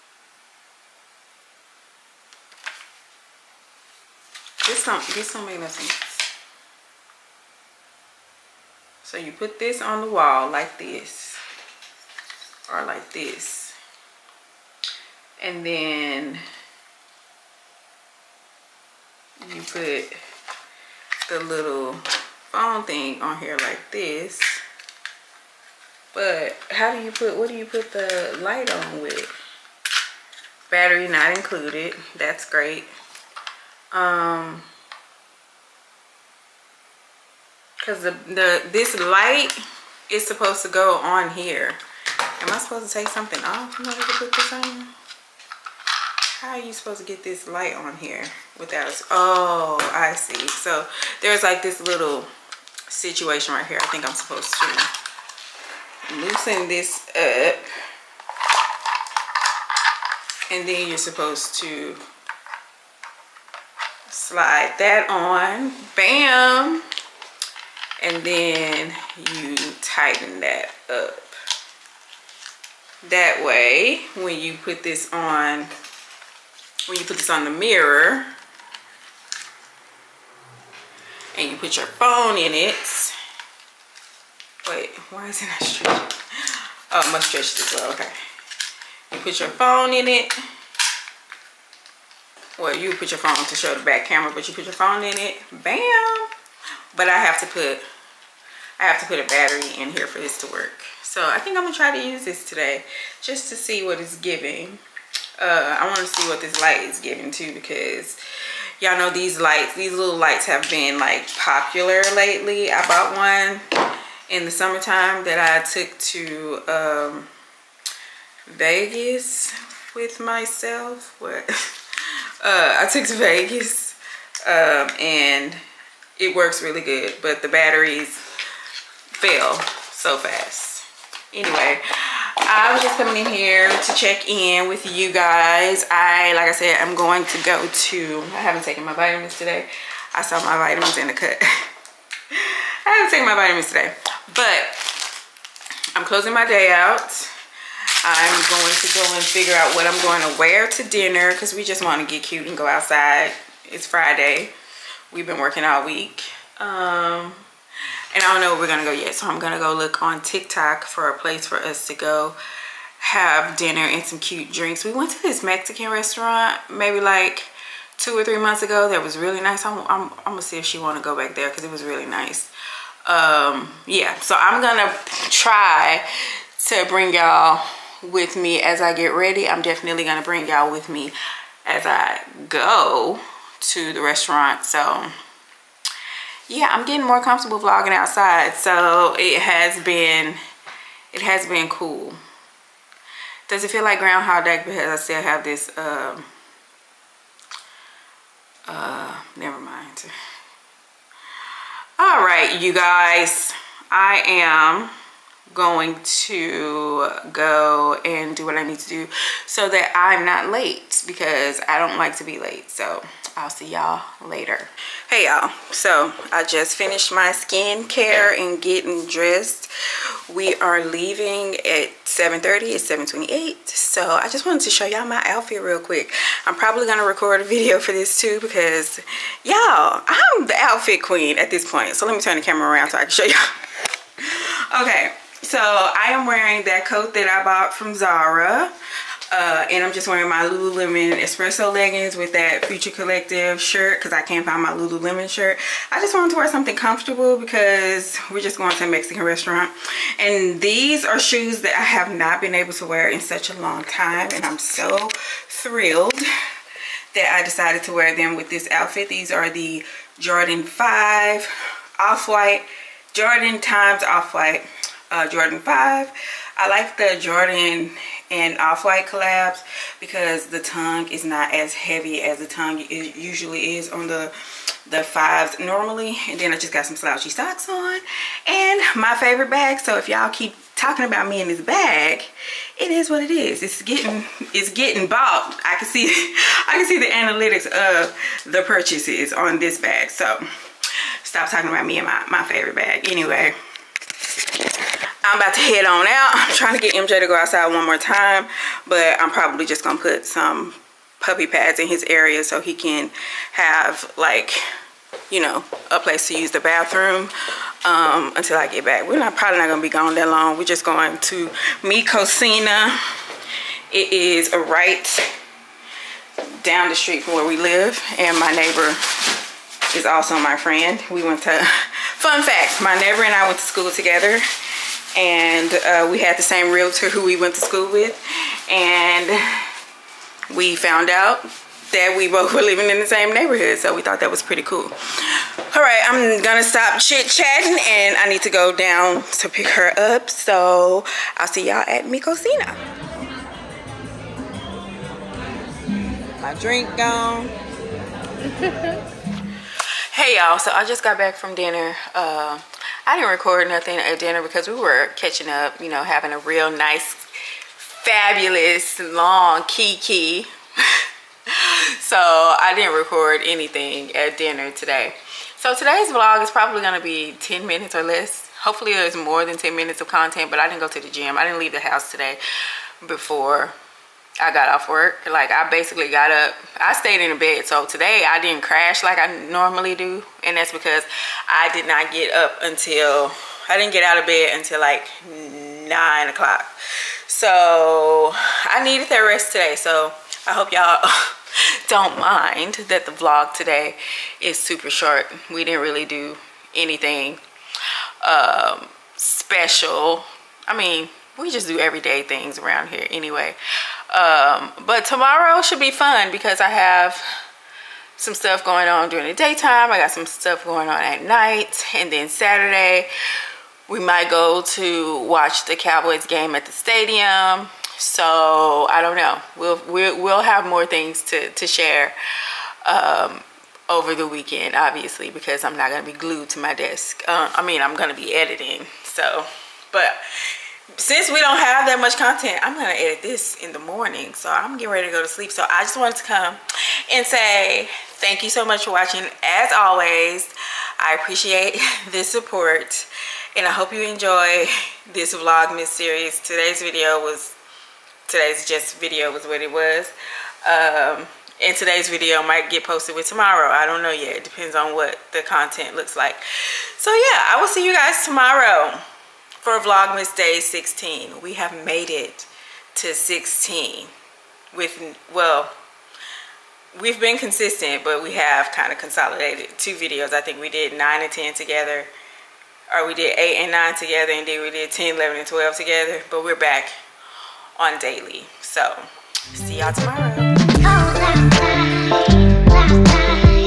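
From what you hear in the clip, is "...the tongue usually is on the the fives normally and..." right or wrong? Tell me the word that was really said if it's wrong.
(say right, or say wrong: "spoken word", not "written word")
right.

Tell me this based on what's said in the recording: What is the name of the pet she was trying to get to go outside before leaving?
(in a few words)
MJ.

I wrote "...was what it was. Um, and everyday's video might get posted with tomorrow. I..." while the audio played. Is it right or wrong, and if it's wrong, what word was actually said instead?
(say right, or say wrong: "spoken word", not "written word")
wrong: "today", not "everyday".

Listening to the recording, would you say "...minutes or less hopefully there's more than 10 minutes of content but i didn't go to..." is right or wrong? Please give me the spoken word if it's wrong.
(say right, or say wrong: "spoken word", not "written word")
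right.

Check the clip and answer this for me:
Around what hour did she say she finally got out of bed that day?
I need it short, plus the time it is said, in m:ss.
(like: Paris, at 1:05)
9 o'clock, at 6:25.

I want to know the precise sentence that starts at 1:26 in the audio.
Oh, I must stretch this well, okay.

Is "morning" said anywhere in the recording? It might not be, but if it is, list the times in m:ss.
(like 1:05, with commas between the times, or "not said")
7:13.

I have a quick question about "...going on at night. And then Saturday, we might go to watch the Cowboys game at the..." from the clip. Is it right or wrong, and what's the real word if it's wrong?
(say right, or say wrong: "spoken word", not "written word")
right.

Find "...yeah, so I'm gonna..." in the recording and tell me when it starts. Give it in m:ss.
2:53.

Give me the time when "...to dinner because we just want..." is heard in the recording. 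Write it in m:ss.
2:30.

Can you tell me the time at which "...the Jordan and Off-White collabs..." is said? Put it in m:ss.
4:26.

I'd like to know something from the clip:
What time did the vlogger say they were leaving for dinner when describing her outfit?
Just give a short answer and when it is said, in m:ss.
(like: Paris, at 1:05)
7:30, at 3:42.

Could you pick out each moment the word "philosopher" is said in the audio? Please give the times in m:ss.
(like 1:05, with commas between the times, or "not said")
not said.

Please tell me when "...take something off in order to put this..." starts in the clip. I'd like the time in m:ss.
0:42.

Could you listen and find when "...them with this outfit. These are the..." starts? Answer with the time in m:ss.
4:18.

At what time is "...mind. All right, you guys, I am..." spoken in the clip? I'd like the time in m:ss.
3:19.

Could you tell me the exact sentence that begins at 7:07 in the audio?
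Uh, I mean, I'm going to be editing.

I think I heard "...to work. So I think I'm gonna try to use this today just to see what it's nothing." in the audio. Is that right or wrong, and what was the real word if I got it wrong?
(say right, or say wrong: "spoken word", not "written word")
wrong: "giving", not "nothing".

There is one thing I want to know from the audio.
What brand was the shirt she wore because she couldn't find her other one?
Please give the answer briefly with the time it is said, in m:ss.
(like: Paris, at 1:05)
Future Collective, at 4:02.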